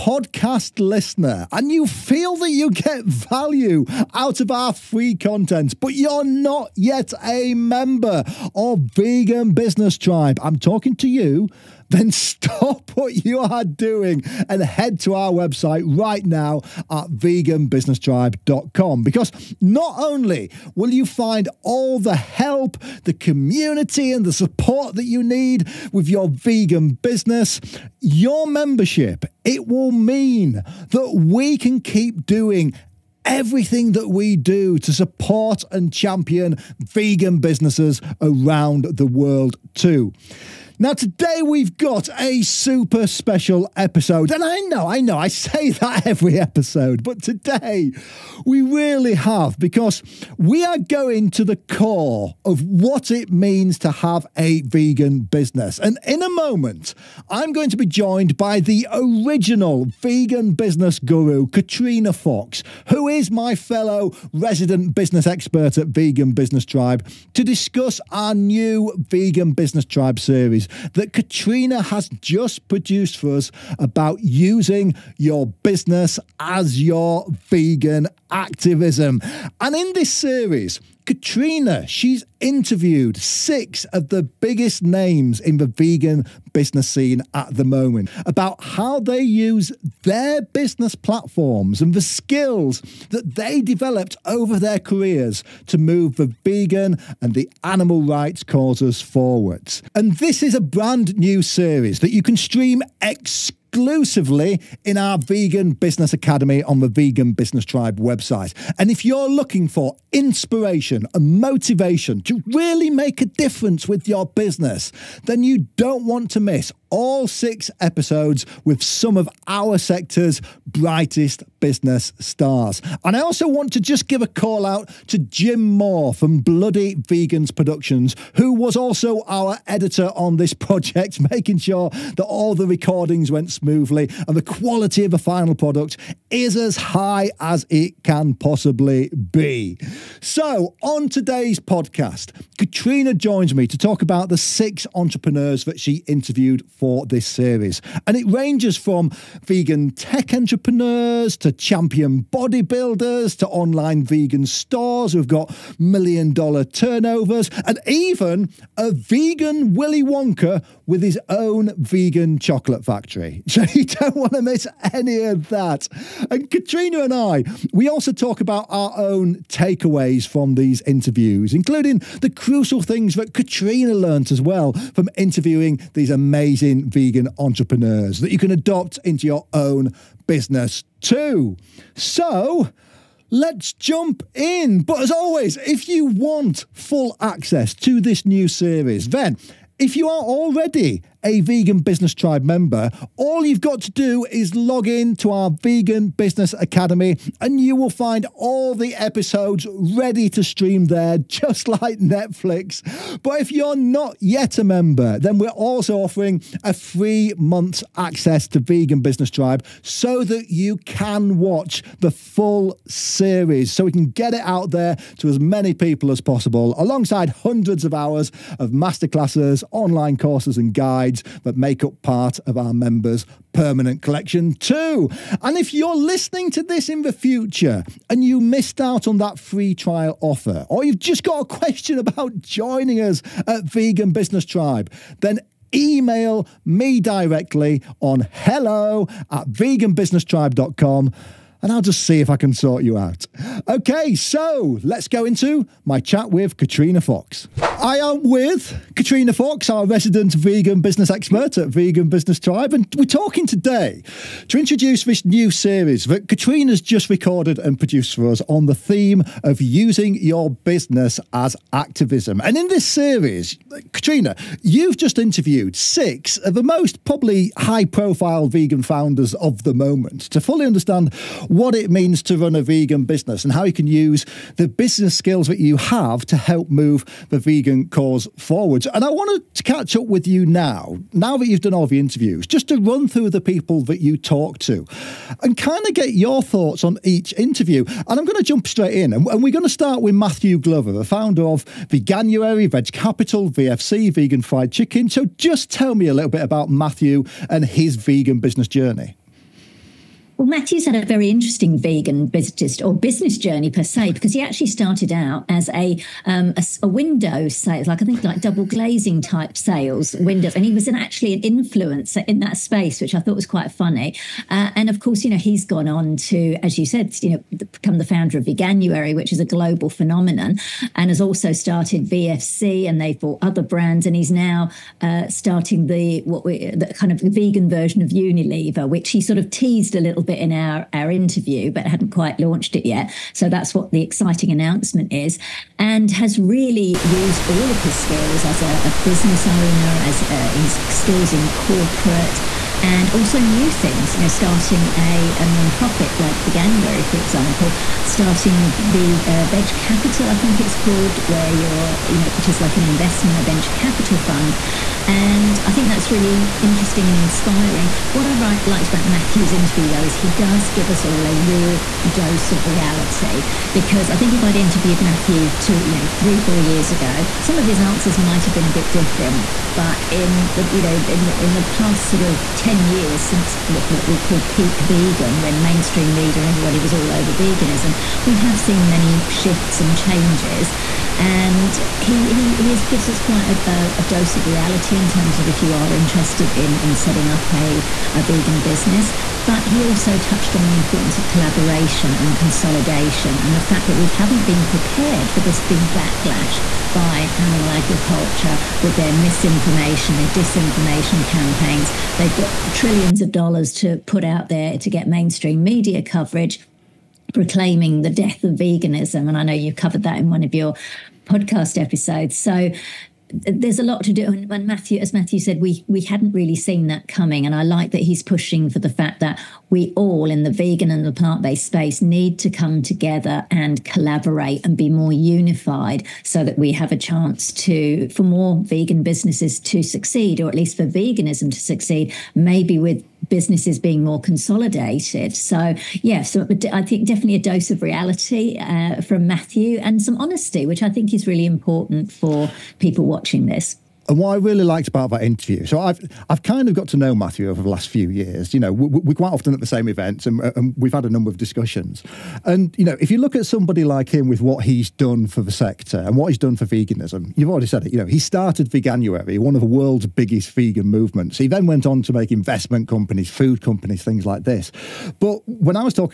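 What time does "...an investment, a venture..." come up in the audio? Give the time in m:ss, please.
5:52.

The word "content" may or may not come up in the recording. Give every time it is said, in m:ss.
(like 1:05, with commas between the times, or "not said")
0:05.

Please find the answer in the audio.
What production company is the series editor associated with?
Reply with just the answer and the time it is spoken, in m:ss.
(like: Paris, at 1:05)
Bloody Vegans Productions, at 2:06.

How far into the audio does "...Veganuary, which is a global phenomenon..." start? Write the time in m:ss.
5:18.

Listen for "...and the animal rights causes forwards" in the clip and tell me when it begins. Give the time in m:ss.
1:37.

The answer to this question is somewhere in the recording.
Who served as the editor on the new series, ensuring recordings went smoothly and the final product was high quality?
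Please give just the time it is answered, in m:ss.
2:05.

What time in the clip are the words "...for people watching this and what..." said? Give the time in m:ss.
7:22.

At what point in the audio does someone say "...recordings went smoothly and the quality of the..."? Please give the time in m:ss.
2:12.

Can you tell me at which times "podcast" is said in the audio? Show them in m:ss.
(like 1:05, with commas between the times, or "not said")
2:21, 6:51.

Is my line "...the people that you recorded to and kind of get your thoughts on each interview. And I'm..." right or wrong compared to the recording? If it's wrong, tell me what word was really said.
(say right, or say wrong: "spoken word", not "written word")
wrong: "talked", not "recorded".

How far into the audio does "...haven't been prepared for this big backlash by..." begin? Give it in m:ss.
6:34.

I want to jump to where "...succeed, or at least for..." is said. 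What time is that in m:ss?
7:09.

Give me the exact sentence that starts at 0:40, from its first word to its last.
Now, today we've got a super special episode.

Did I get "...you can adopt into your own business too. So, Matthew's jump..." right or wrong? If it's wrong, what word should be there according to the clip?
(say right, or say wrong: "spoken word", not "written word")
wrong: "Let", not "Matthew".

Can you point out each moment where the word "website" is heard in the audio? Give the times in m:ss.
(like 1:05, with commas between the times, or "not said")
0:15, 1:47.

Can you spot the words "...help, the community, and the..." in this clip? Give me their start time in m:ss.
0:22.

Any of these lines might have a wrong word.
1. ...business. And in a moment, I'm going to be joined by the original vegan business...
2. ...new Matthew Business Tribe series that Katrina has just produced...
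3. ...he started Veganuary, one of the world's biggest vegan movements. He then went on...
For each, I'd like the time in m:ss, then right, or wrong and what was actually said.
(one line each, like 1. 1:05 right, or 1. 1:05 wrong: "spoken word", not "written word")
1. 0:55 right
2. 1:08 wrong: "Vegan", not "Matthew"
3. 7:38 right.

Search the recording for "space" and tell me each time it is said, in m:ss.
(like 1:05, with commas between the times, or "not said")
5:12, 7:01.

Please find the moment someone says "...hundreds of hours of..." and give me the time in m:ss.
3:37.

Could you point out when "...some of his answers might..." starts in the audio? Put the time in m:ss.
6:07.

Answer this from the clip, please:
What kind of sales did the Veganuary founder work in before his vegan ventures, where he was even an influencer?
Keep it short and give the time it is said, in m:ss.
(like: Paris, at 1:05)
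Window sales, at 5:06.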